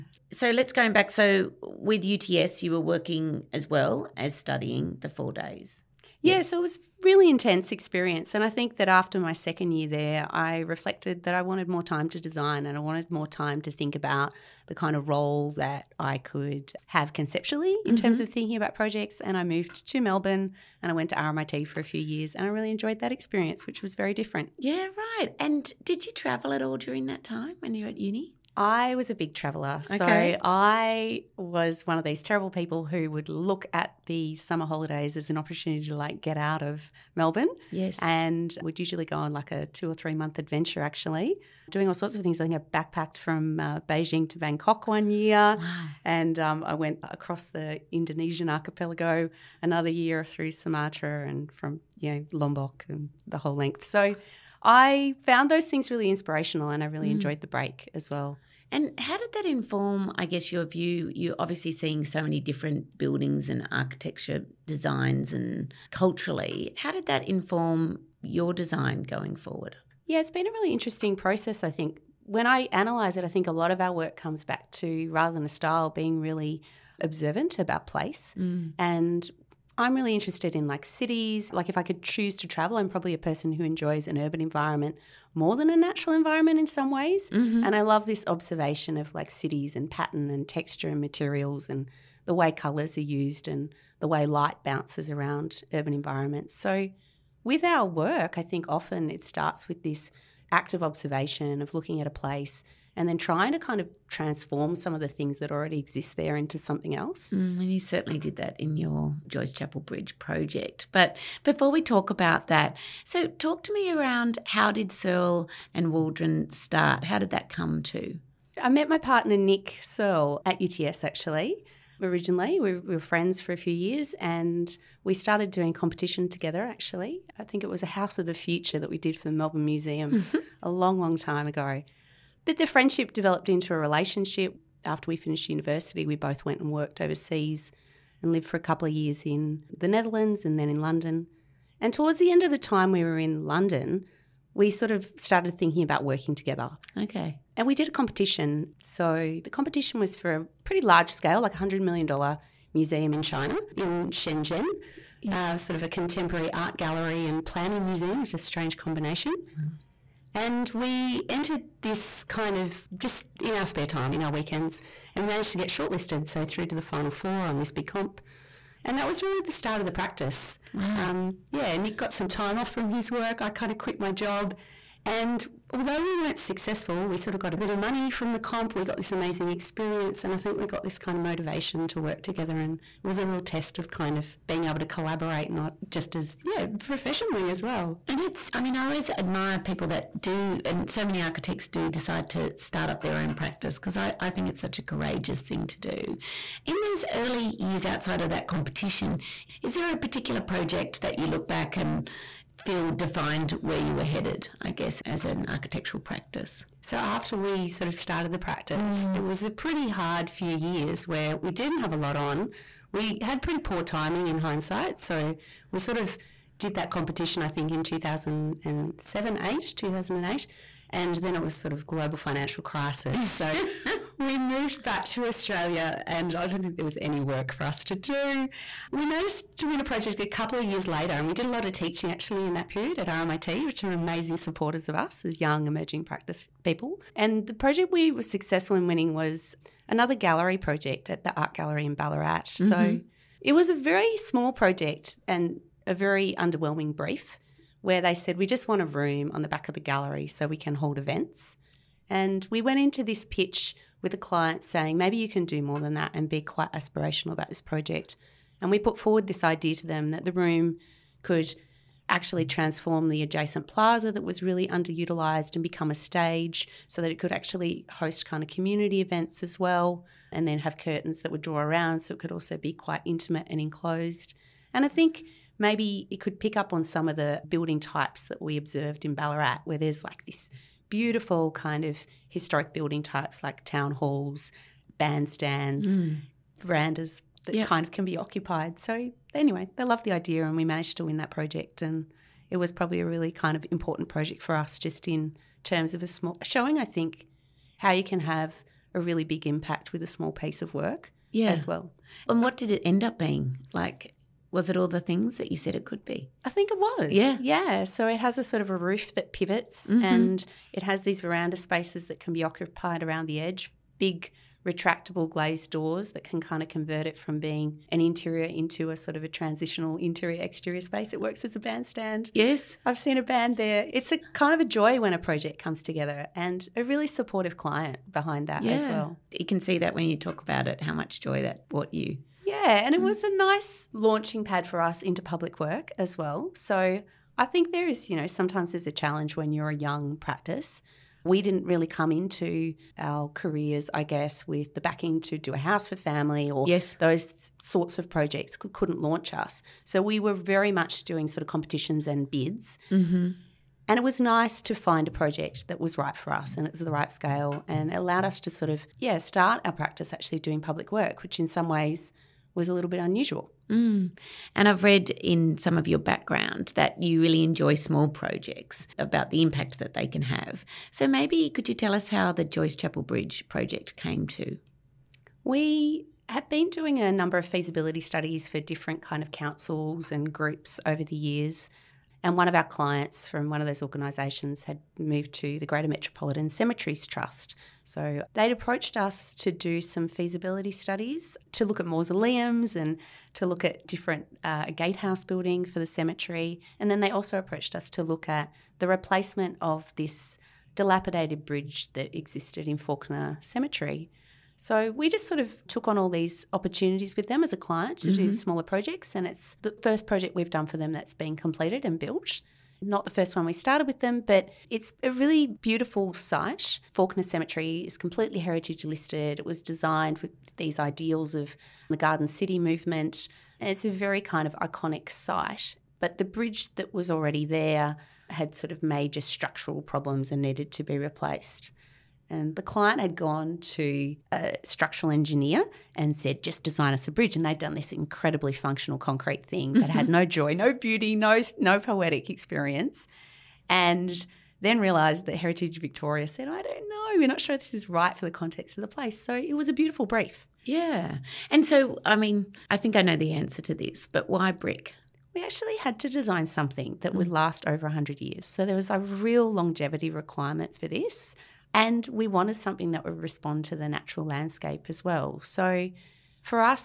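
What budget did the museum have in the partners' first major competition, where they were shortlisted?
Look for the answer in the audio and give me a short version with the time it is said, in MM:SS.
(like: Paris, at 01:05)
$100 million, at 02:31.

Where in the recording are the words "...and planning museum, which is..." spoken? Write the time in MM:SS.
02:37.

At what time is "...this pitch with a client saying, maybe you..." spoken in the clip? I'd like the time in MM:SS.
04:13.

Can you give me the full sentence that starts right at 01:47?
Mm, and you certainly did that in your Joyce Chapel Bridge project.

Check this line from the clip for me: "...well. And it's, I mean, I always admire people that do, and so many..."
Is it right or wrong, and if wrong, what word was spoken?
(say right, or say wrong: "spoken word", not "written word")
right.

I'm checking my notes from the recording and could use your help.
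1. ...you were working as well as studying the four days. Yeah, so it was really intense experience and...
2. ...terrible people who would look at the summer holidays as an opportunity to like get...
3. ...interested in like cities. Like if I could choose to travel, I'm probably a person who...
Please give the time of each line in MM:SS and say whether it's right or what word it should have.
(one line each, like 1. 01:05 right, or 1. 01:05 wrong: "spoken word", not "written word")
1. 00:02 right
2. 00:32 right
3. 01:20 right.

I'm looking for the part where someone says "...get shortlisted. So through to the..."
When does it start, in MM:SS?
02:45.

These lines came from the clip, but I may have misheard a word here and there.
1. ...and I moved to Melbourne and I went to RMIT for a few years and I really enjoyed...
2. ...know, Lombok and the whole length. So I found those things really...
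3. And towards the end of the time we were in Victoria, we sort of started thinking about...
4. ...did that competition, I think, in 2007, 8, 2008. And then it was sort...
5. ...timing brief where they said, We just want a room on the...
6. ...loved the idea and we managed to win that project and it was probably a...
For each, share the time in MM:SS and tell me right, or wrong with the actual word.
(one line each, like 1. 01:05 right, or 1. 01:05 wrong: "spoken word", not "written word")
1. 00:19 right
2. 00:52 right
3. 02:21 wrong: "London", not "Victoria"
4. 03:36 right
5. 04:06 wrong: "underwhelming", not "timing"
6. 04:49 right.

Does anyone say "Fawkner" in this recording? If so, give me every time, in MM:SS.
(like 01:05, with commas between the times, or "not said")
06:42, 06:56.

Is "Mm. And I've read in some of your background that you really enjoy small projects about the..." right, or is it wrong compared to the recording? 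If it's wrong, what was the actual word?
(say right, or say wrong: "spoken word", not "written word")
right.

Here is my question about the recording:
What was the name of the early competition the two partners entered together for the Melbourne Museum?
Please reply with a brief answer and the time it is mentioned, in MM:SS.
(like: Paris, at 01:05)
House of the Future, at 02:07.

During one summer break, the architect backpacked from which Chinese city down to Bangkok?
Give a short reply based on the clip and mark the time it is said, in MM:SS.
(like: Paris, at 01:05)
Beijing, at 00:43.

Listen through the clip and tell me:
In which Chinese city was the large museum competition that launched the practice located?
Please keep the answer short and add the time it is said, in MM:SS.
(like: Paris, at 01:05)
Shenzhen, at 02:34.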